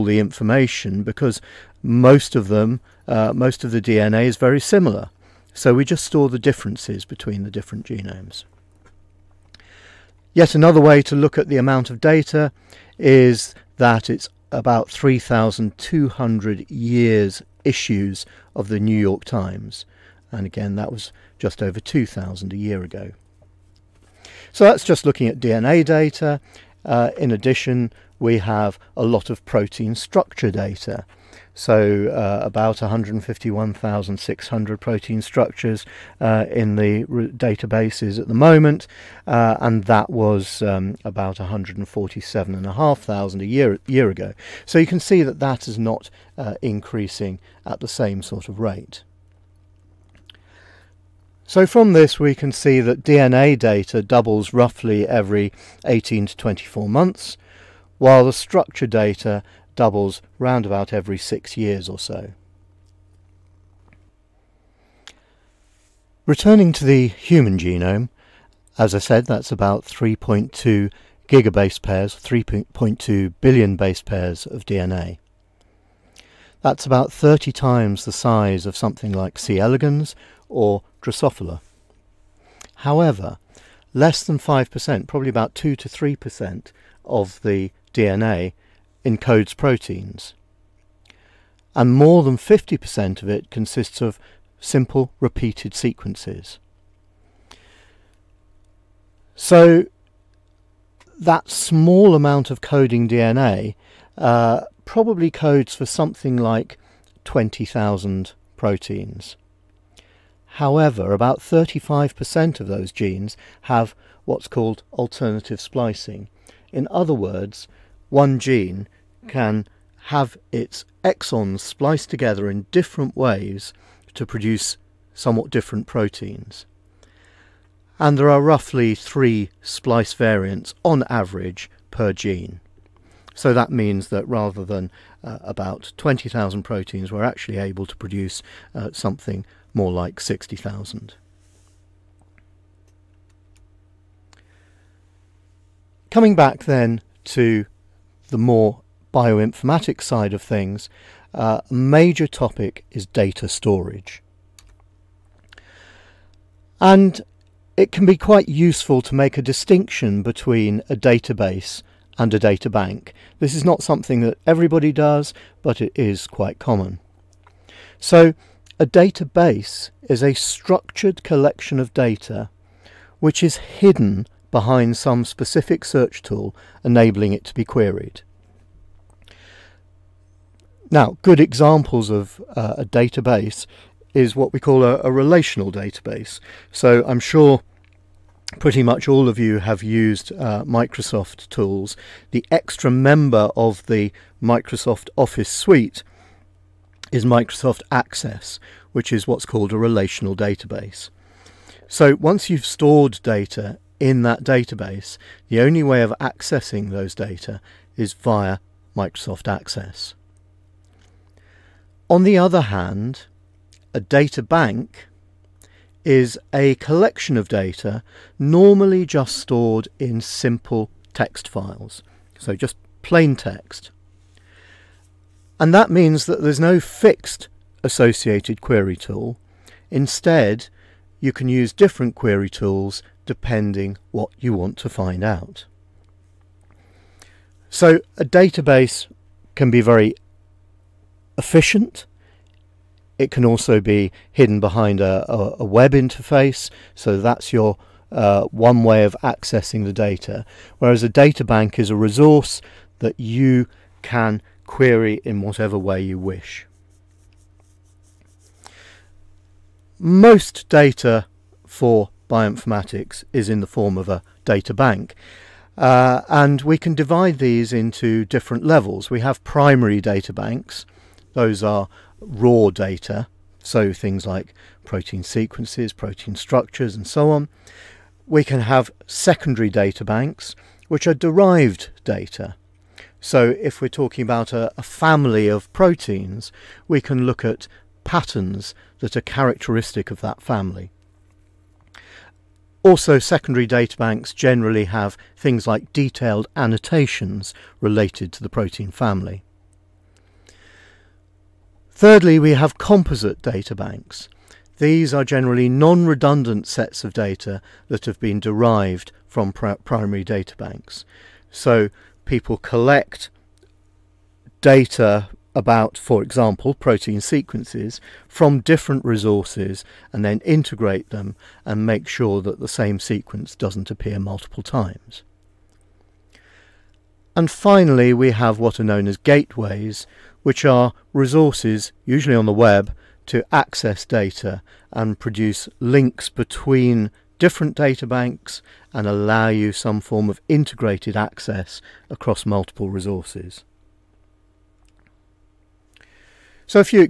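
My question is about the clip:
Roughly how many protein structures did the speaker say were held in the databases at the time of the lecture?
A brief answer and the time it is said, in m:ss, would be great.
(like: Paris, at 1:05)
151,600, at 0:32.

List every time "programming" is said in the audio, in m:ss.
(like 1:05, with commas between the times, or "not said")
not said.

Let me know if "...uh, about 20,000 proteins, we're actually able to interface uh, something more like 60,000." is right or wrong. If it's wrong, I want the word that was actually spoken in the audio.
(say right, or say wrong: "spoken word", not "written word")
wrong: "produce", not "interface".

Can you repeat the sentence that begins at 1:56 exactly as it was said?
In other words, one gene can have its exons spliced together in different ways to produce somewhat different proteins.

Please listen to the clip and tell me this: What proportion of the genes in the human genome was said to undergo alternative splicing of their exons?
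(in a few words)
35%.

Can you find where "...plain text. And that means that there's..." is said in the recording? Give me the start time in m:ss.
3:43.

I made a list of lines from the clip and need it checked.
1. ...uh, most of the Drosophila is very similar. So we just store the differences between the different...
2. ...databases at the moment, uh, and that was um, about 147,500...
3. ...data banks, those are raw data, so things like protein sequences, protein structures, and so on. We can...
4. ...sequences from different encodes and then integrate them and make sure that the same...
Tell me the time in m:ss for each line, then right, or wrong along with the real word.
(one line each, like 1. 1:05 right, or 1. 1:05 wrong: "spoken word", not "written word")
1. 0:03 wrong: "DNA", not "Drosophila"
2. 0:37 right
3. 4:30 right
4. 5:17 wrong: "resources", not "encodes".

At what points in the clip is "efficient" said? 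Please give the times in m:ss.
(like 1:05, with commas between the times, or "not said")
4:01.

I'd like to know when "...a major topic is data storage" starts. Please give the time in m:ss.
2:31.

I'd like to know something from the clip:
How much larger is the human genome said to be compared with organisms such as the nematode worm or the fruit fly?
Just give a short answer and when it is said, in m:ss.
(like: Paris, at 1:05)
30 times, at 1:17.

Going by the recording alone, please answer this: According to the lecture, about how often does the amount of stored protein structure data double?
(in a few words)
every 6 years.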